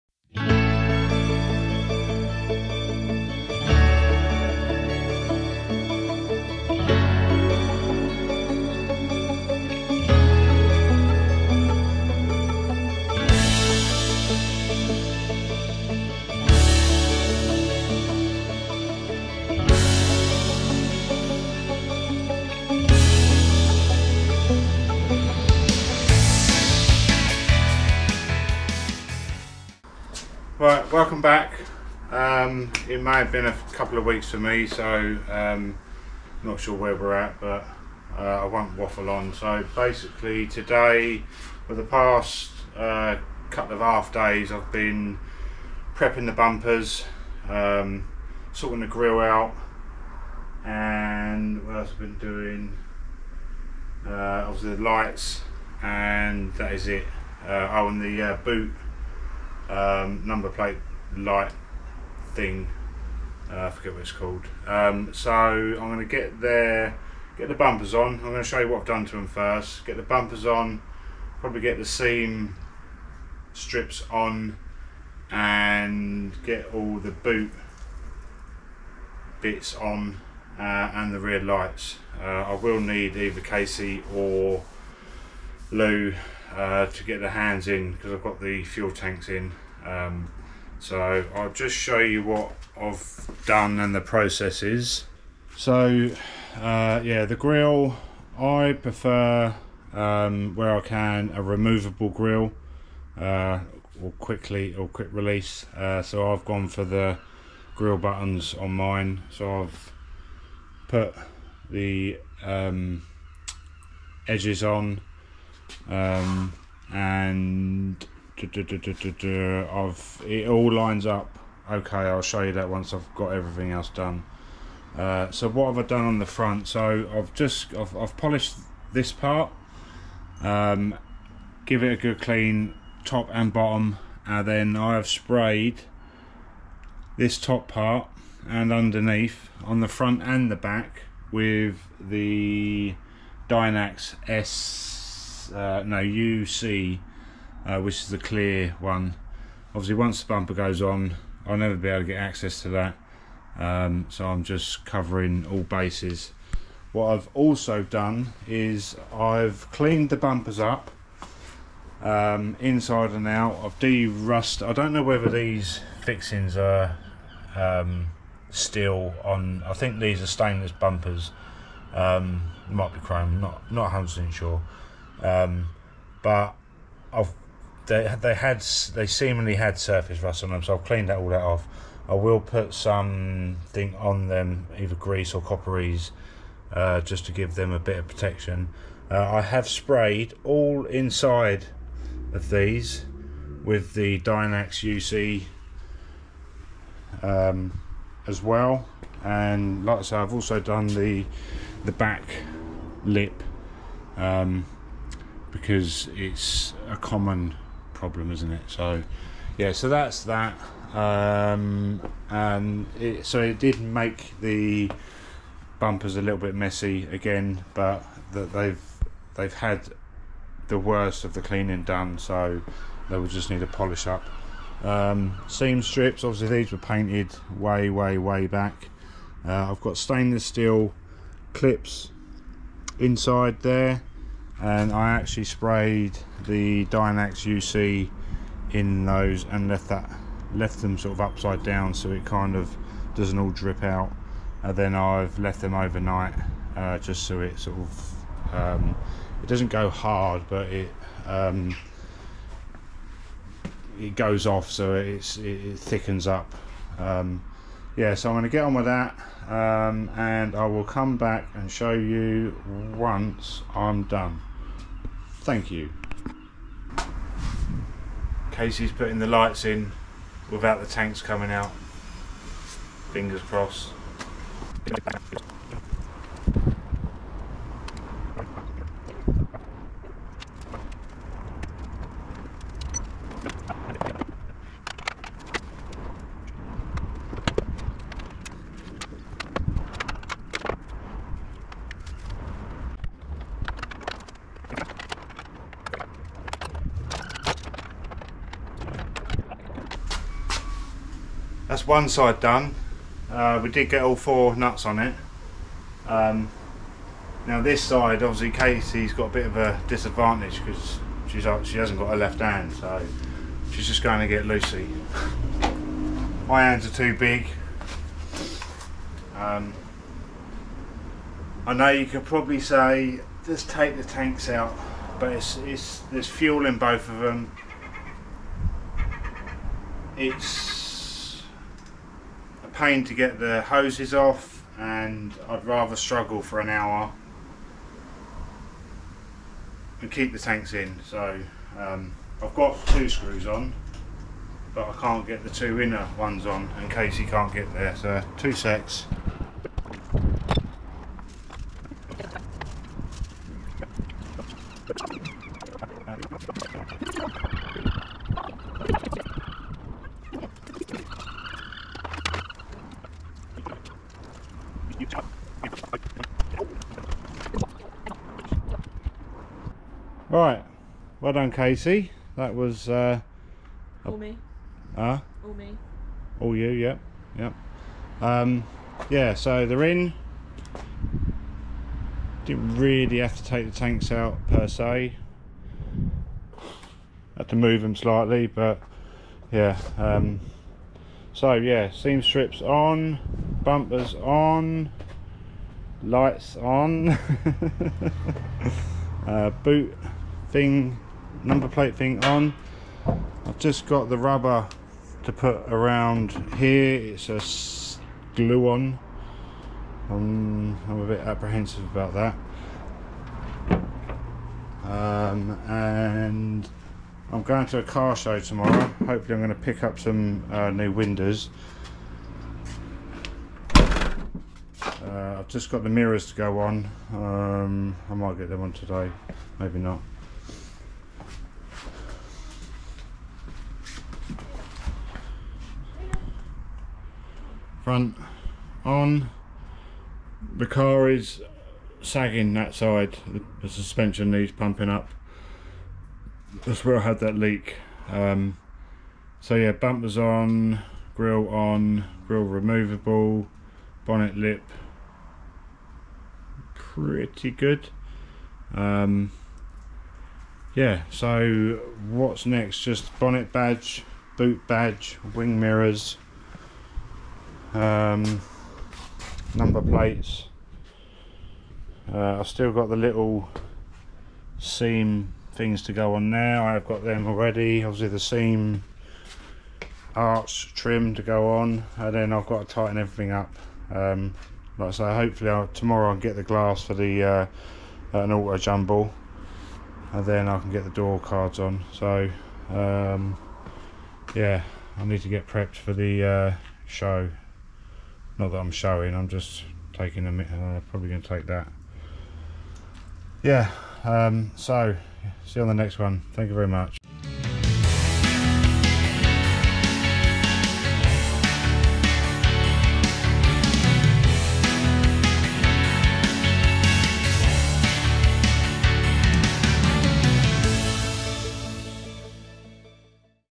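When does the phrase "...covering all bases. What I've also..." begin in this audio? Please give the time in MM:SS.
02:34.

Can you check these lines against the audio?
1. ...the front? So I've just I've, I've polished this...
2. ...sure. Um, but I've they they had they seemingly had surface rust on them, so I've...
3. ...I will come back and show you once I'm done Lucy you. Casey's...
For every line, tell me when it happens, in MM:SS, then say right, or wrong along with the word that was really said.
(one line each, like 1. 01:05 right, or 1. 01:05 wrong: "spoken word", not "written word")
1. 02:06 right
2. 02:54 right
3. 04:20 wrong: "Thank", not "Lucy".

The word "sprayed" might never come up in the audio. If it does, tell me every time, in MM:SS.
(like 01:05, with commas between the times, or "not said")
02:15, 03:09, 03:55.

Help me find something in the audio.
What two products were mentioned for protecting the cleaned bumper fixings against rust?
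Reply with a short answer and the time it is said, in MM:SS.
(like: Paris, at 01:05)
Grease or copperies, at 03:04.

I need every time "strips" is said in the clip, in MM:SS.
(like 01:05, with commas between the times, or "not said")
01:13, 03:45, 06:32.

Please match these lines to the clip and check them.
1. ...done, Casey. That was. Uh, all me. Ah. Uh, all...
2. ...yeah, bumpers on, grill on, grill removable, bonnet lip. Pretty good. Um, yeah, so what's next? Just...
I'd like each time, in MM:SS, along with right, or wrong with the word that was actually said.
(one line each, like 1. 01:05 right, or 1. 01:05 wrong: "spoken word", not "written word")
1. 06:11 right
2. 07:29 right.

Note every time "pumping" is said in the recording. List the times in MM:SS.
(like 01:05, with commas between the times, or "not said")
07:24.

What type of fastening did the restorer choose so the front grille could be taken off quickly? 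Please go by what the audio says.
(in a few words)
Grill buttons.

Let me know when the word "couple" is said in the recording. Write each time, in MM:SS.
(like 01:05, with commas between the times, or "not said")
00:33, 00:43.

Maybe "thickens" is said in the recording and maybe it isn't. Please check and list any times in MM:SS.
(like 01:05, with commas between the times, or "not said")
04:15.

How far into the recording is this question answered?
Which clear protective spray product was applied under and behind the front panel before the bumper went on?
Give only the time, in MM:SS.
02:23.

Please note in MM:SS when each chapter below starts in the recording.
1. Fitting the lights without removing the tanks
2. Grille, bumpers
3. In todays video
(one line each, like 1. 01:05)
1. 04:27
2. 01:35
3. 00:32.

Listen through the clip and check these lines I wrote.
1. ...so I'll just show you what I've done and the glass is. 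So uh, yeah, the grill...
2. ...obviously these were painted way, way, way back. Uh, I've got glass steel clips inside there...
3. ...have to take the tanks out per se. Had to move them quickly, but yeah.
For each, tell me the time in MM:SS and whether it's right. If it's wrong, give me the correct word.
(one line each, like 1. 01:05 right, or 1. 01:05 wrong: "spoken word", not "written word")
1. 01:30 wrong: "process", not "glass"
2. 03:46 wrong: "stainless", not "glass"
3. 06:23 wrong: "slightly", not "quickly".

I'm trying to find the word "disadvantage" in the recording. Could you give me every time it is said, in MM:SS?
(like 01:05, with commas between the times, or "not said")
05:09.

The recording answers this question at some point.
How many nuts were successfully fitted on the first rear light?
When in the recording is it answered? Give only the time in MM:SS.
05:04.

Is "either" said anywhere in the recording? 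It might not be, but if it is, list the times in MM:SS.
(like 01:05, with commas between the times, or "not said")
01:23, 03:04.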